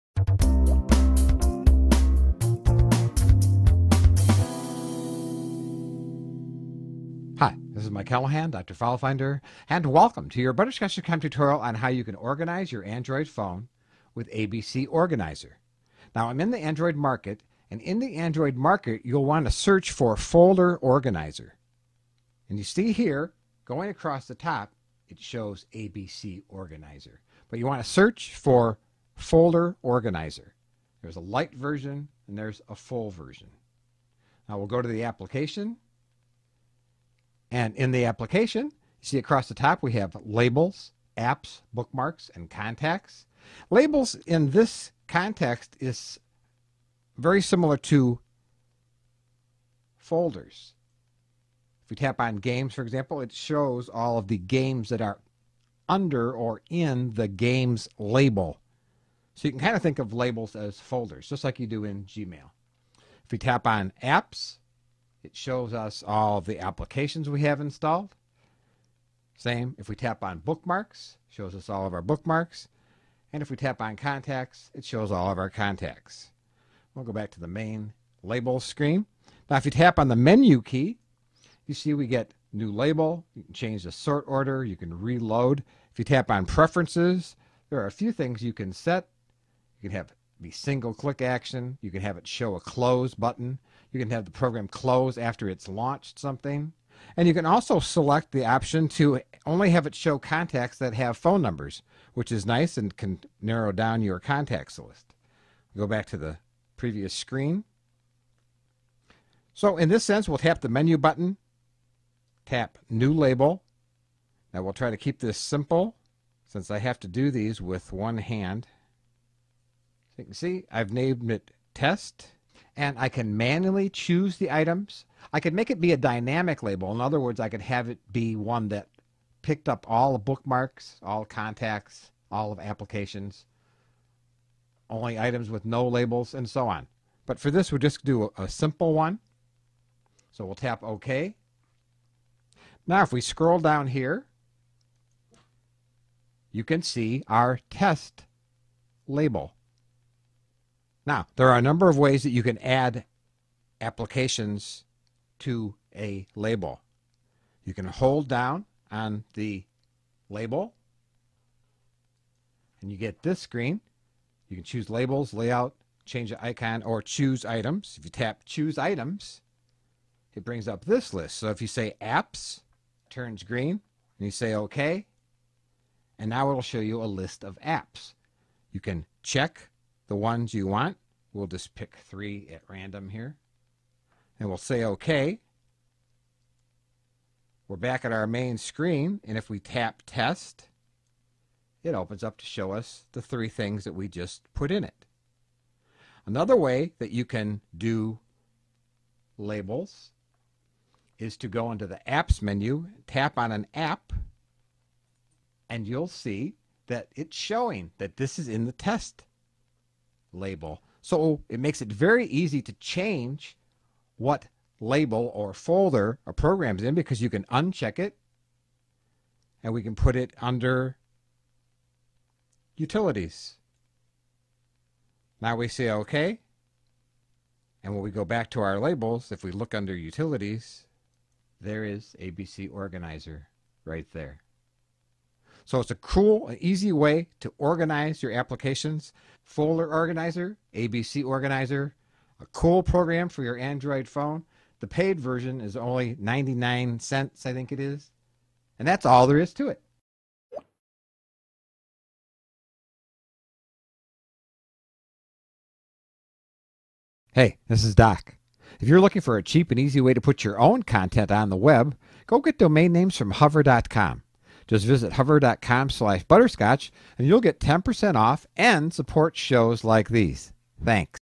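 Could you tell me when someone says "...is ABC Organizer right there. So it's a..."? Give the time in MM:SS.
03:51.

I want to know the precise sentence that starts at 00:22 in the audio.
And you see here, going across the top, it shows ABC Organizer.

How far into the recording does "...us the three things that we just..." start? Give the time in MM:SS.
03:12.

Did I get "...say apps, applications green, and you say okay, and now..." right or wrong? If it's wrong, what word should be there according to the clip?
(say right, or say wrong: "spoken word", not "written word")
wrong: "turns", not "applications".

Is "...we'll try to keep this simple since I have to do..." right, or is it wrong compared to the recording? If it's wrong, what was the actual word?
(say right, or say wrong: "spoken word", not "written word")
right.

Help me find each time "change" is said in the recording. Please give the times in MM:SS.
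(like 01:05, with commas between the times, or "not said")
01:23, 02:46, 03:32.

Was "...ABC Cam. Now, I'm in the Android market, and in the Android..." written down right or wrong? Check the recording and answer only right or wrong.
wrong.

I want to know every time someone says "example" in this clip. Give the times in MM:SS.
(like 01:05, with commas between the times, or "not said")
00:52.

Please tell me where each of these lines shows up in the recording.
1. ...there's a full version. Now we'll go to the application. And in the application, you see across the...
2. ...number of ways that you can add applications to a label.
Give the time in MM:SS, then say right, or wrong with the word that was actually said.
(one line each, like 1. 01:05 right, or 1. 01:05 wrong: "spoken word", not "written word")
1. 00:32 right
2. 02:31 right.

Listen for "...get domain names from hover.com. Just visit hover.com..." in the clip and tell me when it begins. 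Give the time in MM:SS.
04:22.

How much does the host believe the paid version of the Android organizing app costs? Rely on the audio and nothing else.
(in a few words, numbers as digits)
99 cents.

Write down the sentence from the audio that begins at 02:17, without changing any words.
But for this, we'll just do a, a simple one.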